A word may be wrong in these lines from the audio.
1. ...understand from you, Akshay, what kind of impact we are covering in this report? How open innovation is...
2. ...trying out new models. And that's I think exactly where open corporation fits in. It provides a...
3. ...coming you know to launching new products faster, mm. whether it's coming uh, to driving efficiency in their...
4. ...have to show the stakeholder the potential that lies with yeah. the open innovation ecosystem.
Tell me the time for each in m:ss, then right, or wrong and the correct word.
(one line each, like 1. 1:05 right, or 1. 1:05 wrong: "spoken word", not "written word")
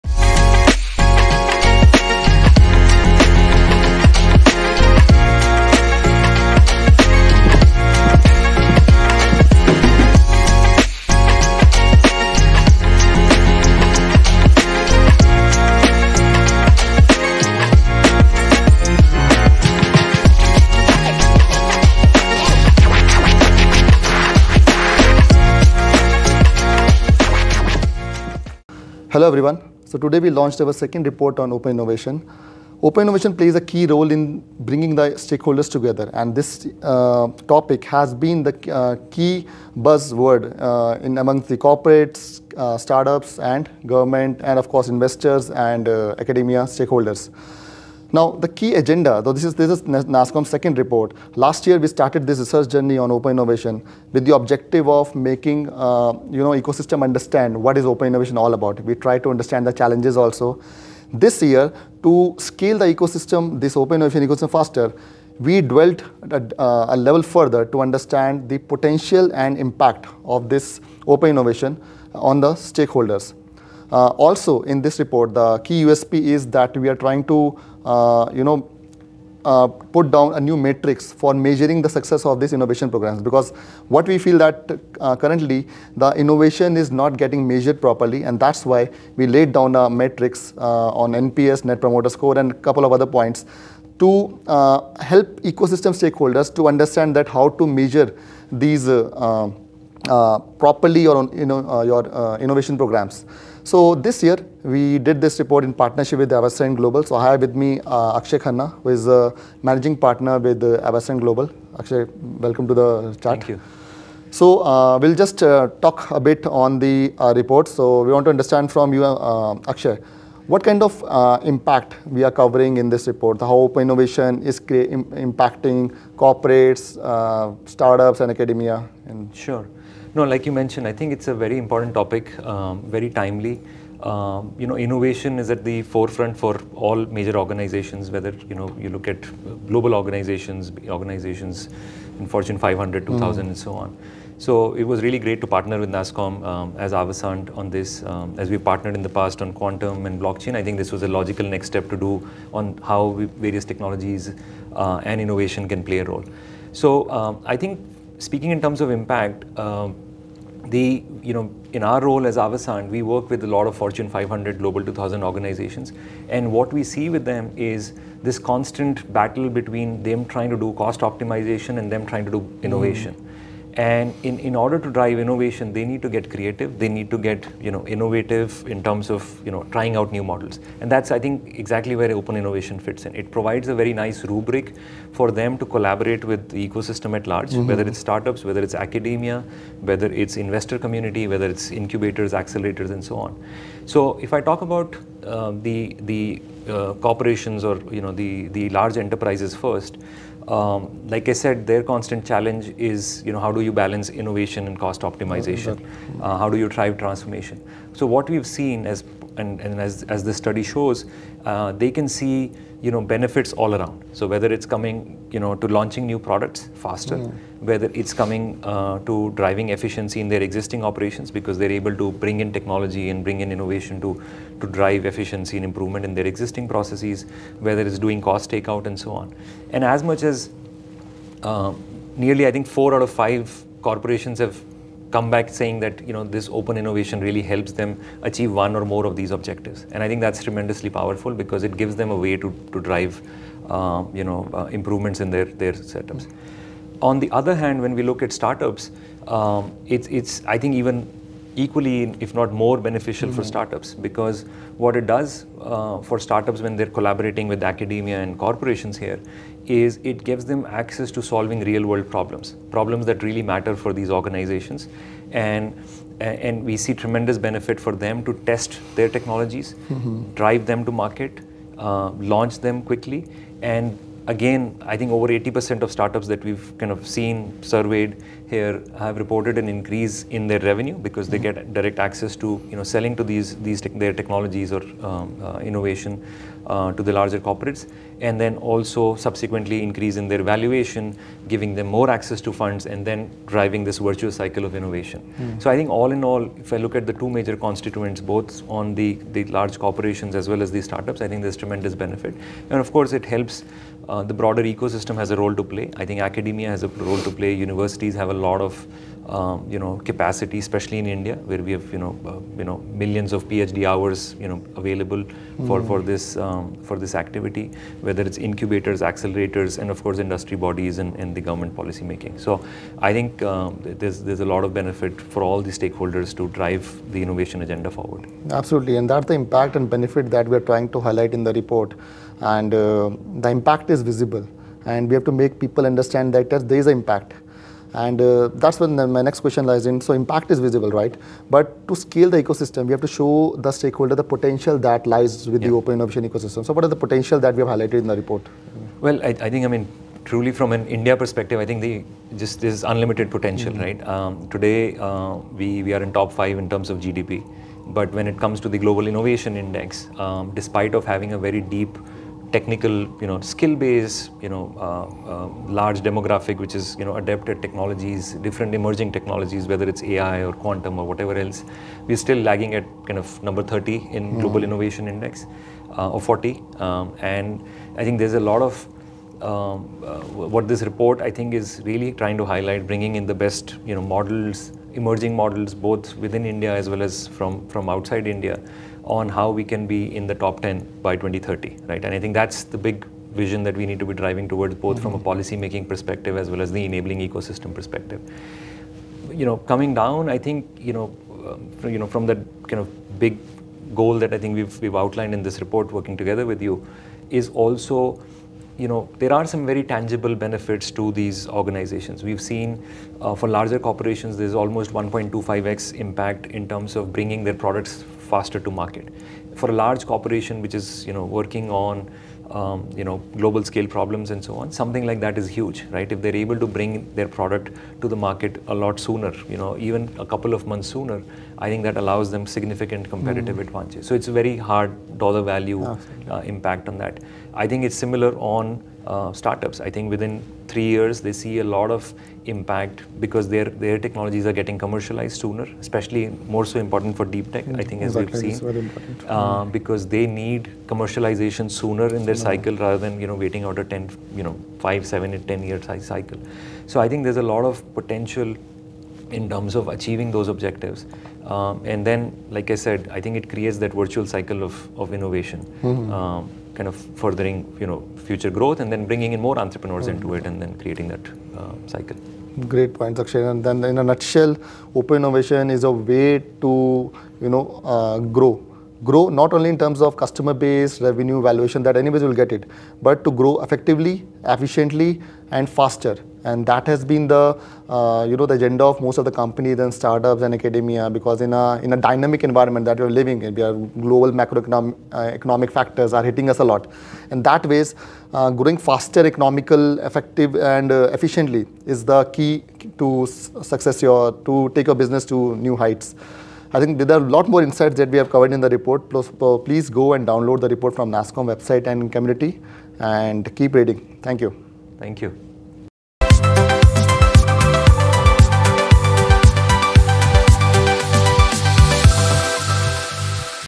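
1. 1:58 right
2. 2:59 wrong: "innovation", not "corporation"
3. 3:34 right
4. 5:42 right.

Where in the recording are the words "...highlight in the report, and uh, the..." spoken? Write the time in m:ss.
5:30.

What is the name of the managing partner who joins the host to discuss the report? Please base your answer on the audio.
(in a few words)
Akshay Khanna.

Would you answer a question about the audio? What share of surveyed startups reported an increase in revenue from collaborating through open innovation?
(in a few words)
over 80%.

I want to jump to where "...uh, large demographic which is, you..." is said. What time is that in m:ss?
6:05.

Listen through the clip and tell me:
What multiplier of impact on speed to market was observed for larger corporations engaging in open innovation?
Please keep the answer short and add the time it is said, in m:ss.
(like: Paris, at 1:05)
1.25x, at 6:54.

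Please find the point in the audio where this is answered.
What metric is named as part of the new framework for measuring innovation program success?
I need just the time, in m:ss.
1:31.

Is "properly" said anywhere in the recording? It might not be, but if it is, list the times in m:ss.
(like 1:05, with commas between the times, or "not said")
1:27, 1:40.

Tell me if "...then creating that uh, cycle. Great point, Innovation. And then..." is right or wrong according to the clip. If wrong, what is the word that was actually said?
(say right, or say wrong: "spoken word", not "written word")
wrong: "Akshay", not "Innovation".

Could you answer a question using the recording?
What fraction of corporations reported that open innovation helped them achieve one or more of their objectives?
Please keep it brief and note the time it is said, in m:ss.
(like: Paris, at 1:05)
4 out of 5, at 3:52.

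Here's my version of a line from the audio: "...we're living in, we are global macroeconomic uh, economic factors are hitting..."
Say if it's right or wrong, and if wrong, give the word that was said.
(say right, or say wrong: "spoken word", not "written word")
right.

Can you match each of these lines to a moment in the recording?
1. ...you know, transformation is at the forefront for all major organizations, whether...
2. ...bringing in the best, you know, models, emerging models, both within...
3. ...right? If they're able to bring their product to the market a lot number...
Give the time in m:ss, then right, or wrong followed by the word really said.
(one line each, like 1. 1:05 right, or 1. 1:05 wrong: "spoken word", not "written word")
1. 2:14 wrong: "innovation", not "transformation"
2. 6:22 right
3. 7:05 wrong: "sooner", not "number".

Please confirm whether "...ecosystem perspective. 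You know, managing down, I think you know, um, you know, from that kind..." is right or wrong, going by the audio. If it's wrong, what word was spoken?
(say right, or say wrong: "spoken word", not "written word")
wrong: "coming", not "managing".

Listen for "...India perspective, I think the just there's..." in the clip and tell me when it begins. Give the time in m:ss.
5:50.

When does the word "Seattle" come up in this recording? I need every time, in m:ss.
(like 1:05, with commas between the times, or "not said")
not said.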